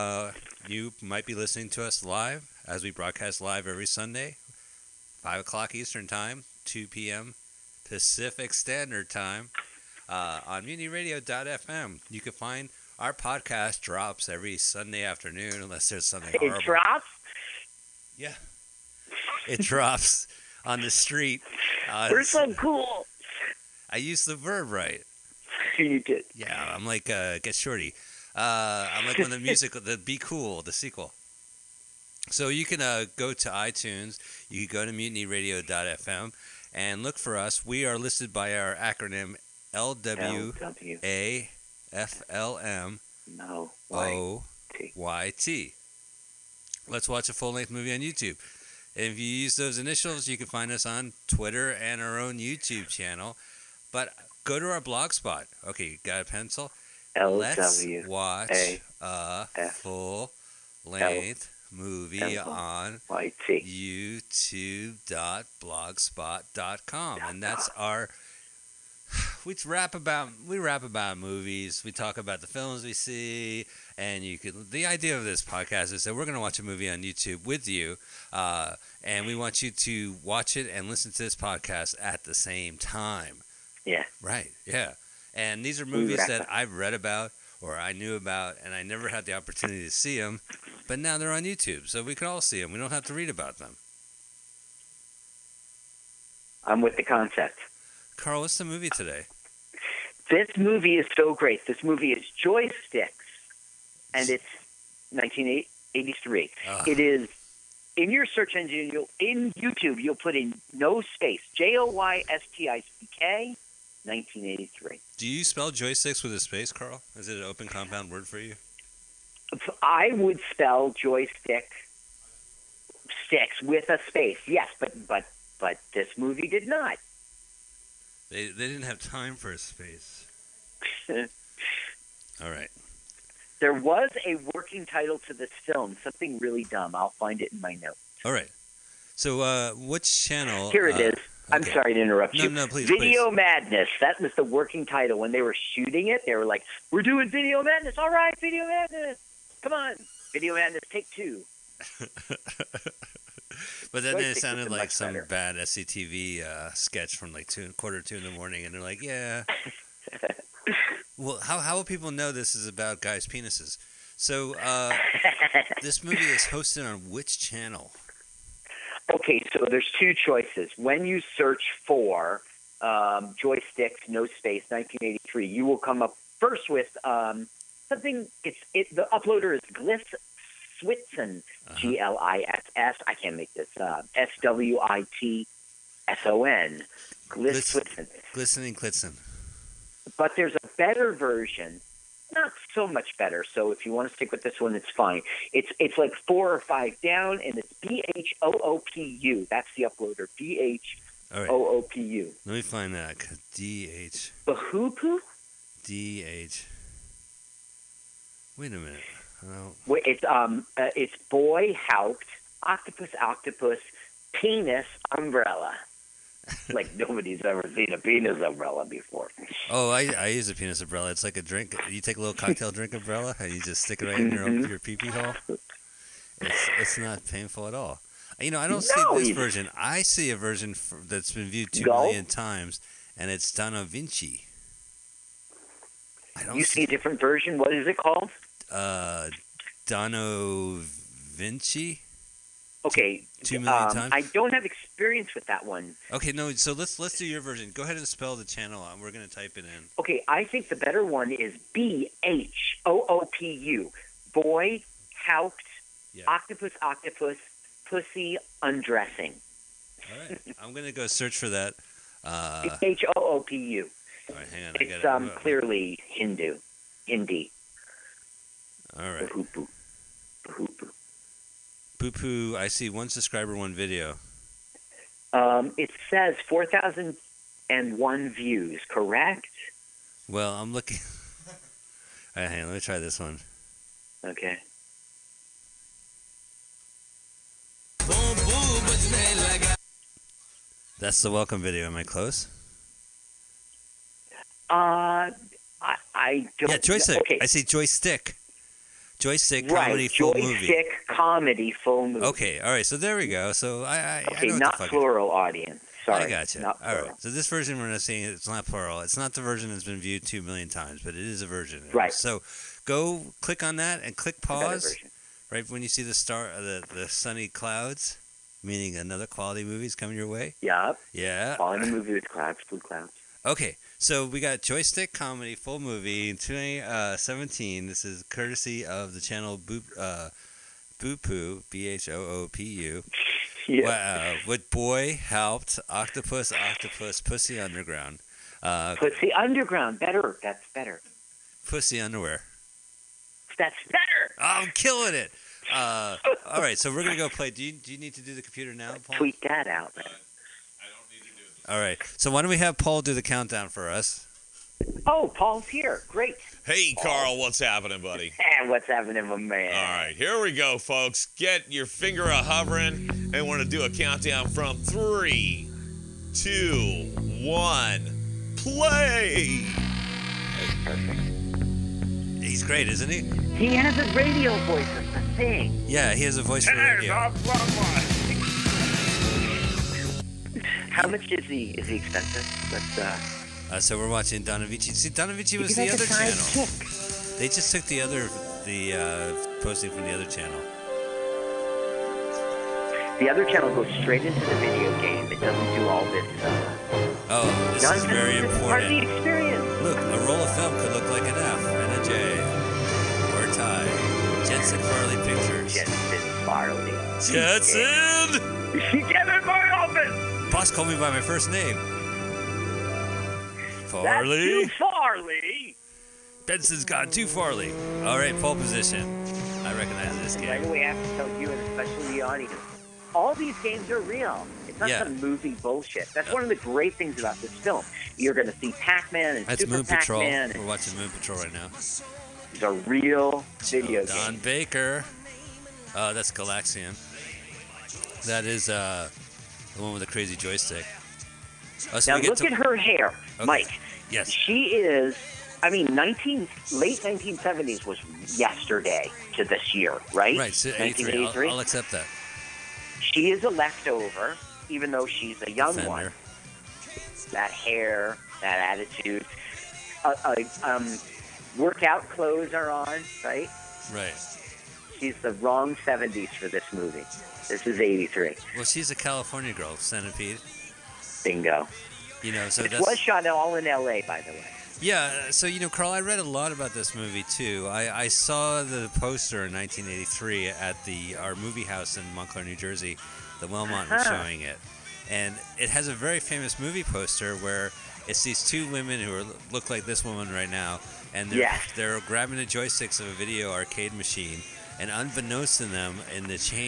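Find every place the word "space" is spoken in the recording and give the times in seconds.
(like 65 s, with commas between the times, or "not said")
110 s, 116 s, 124 s, 129 s, 174 s.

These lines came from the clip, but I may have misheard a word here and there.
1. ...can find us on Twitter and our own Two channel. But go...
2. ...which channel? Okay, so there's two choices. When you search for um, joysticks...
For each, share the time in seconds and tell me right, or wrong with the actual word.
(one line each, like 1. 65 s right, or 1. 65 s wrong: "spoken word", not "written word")
1. 50 s wrong: "YouTube", not "Two"
2. 167 s right.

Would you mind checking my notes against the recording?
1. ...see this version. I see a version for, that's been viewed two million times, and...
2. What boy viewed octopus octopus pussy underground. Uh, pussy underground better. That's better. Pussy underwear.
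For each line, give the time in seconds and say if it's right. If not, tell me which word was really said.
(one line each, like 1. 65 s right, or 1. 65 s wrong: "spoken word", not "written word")
1. 229 s right
2. 334 s wrong: "helped", not "viewed".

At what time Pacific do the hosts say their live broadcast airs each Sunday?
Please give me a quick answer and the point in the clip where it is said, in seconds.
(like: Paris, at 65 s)
2 p.m., at 6 s.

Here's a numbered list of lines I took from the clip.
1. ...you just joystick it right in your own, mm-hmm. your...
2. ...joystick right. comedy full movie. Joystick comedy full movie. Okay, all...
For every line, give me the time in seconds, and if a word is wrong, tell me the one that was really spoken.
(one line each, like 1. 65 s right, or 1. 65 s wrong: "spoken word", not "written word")
1. 223 s wrong: "stick", not "joystick"
2. 299 s right.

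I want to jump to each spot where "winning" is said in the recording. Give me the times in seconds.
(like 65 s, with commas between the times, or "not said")
not said.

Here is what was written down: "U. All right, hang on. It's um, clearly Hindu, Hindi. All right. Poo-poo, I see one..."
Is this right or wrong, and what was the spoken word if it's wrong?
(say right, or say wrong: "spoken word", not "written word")
right.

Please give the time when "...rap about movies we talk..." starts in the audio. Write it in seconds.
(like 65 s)
70 s.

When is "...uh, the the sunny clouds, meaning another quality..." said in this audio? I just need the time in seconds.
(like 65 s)
316 s.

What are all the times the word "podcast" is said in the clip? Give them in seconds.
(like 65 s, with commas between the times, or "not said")
13 s, 75 s, 81 s.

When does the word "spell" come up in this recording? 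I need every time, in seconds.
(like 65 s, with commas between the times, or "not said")
115 s, 120 s, 248 s.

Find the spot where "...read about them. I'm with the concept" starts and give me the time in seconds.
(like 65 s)
93 s.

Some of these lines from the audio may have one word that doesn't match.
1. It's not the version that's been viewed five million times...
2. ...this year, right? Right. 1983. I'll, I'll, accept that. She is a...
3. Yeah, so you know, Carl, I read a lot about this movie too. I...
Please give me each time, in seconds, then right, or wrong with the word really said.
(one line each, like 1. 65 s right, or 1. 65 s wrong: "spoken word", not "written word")
1. 308 s wrong: "two", not "five"
2. 449 s right
3. 474 s right.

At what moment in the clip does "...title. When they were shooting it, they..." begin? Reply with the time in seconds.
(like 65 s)
144 s.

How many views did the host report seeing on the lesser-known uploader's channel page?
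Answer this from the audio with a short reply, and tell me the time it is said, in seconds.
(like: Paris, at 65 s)
4,001, at 276 s.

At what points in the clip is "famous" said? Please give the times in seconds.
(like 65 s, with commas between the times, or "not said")
486 s.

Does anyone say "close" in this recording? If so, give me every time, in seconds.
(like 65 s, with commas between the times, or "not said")
292 s.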